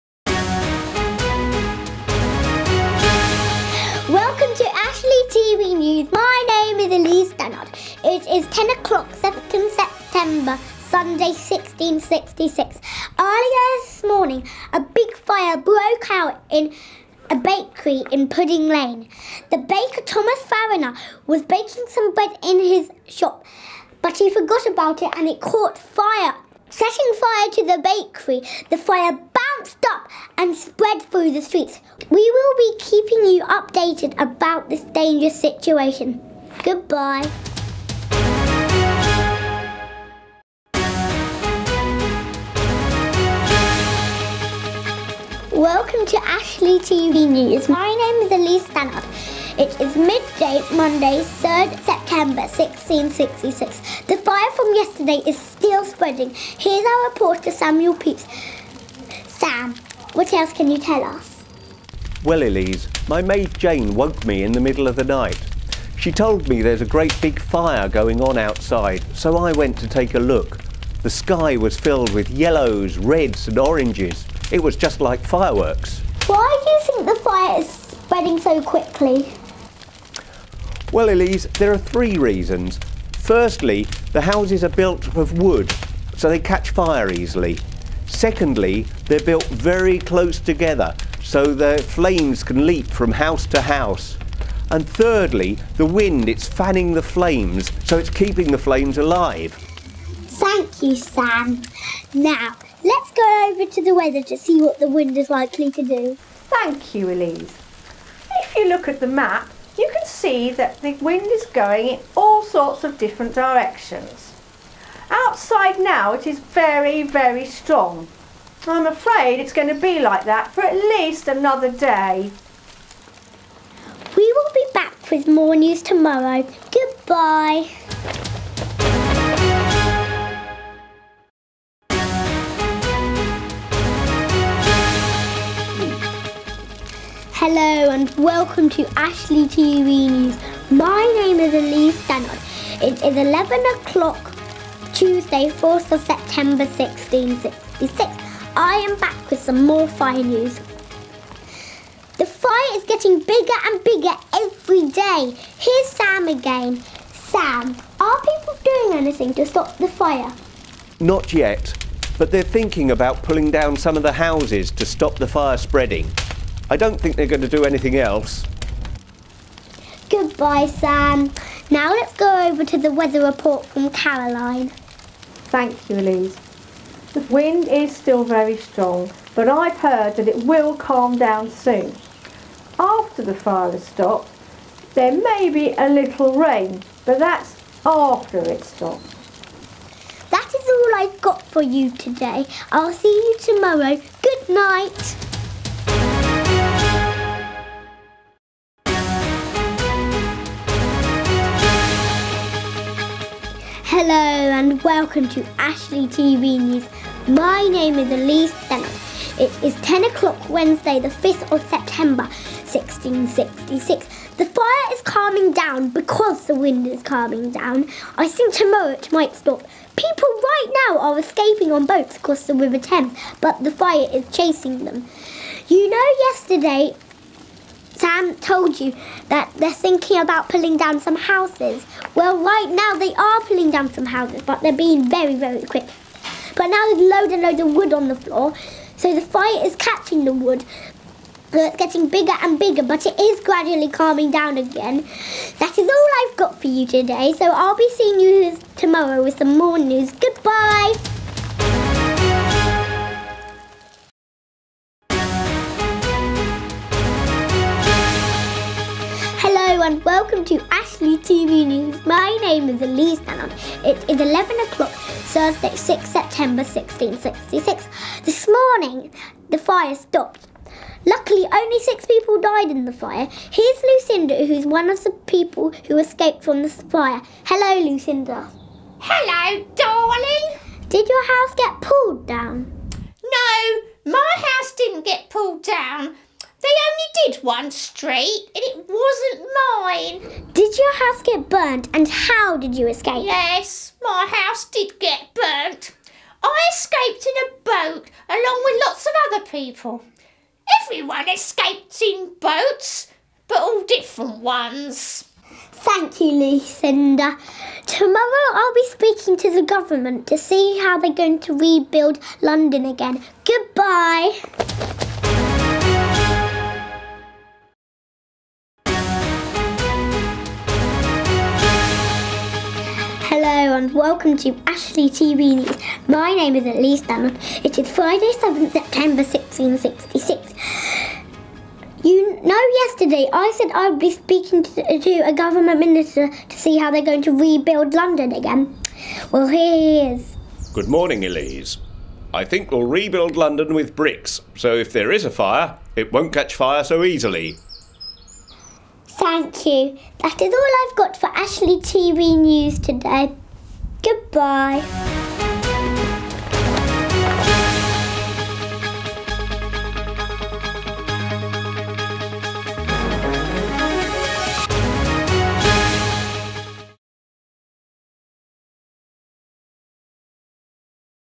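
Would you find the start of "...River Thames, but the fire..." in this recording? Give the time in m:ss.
3:42.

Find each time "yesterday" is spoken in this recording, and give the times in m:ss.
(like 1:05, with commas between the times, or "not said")
0:54, 3:46, 5:32.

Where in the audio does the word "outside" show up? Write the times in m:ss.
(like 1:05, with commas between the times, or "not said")
1:08, 1:55.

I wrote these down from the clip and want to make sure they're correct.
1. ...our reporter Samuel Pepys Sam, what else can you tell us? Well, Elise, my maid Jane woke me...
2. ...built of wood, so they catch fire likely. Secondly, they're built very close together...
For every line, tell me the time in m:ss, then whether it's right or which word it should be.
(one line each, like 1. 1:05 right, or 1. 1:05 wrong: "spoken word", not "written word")
1. 0:56 right
2. 1:24 wrong: "easily", not "likely".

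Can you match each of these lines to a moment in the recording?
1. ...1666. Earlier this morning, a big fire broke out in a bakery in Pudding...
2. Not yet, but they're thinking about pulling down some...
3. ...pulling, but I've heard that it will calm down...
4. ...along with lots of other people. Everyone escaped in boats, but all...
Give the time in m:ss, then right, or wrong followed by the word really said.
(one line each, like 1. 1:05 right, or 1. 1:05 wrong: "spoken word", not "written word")
1. 0:11 right
2. 2:40 right
3. 2:58 wrong: "strong", not "pulling"
4. 4:58 right.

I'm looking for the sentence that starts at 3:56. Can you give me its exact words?
But now there's loads and loads of wood on the floor, so the fire is catching the wood.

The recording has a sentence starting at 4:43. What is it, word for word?
No, my house didn't get pulled down.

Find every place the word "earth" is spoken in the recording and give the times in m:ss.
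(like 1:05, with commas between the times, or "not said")
not said.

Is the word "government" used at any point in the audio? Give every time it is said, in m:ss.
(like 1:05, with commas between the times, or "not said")
5:09, 5:35.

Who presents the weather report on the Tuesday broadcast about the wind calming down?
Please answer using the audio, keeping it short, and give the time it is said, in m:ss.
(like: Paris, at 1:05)
Caroline, at 2:53.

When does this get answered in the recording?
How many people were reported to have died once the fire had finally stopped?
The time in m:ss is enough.
4:31.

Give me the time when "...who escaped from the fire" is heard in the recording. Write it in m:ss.
4:35.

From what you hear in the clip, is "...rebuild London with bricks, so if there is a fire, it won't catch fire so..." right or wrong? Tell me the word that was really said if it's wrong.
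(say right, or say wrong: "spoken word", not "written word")
right.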